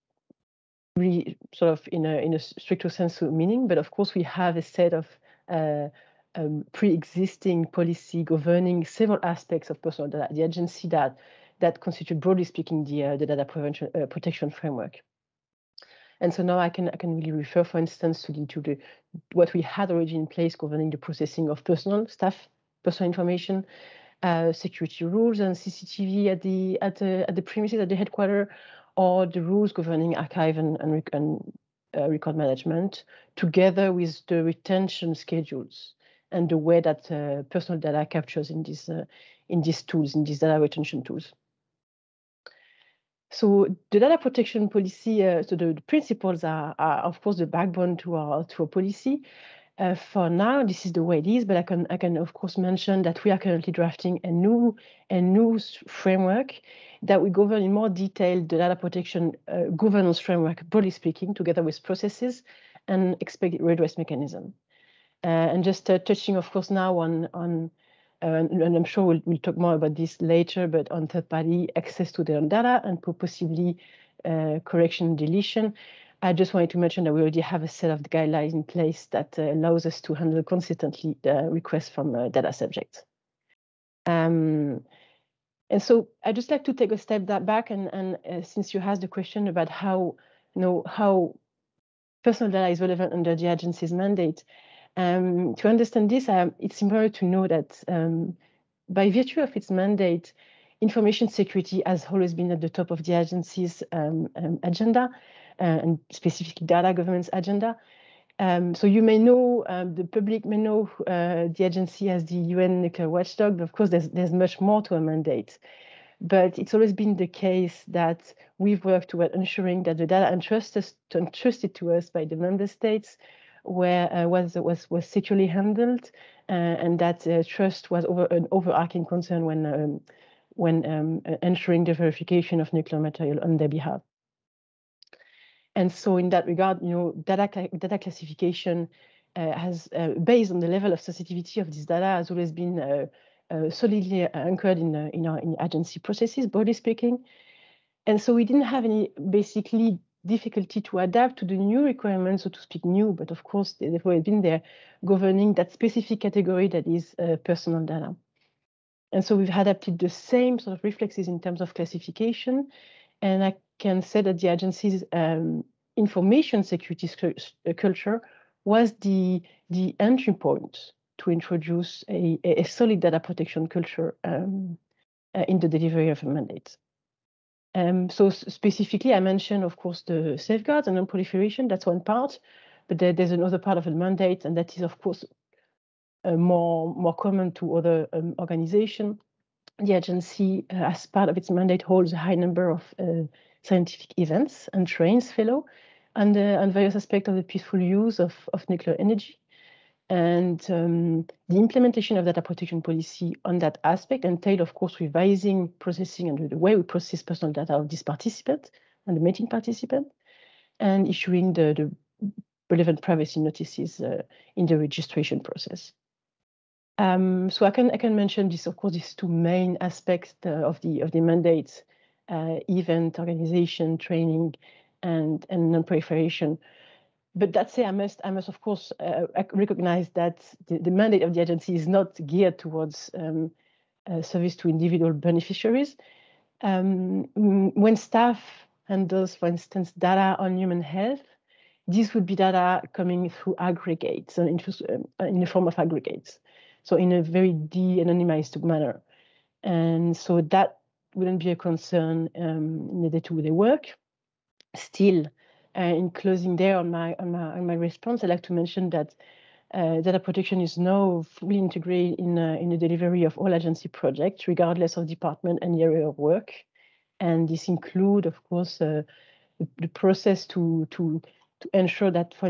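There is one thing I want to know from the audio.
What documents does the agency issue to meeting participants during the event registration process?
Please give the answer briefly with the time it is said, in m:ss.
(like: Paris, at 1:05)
privacy notices, at 3:33.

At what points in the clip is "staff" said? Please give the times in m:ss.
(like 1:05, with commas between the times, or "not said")
0:22, 3:57.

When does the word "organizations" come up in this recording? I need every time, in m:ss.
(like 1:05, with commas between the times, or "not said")
3:08, 3:43.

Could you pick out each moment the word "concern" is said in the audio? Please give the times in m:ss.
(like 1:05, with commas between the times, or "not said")
2:09, 4:11.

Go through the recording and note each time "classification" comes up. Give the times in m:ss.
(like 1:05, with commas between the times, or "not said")
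2:17, 2:41.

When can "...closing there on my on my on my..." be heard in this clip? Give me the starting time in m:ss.
4:16.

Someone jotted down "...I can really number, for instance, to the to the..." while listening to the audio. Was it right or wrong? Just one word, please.
wrong.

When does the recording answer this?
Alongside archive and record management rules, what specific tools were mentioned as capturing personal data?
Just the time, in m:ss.
0:34.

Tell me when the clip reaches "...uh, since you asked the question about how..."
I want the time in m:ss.
1:28.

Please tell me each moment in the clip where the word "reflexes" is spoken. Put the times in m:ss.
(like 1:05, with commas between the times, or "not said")
2:40.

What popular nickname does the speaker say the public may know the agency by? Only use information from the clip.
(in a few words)
the UN nuclear watchdog.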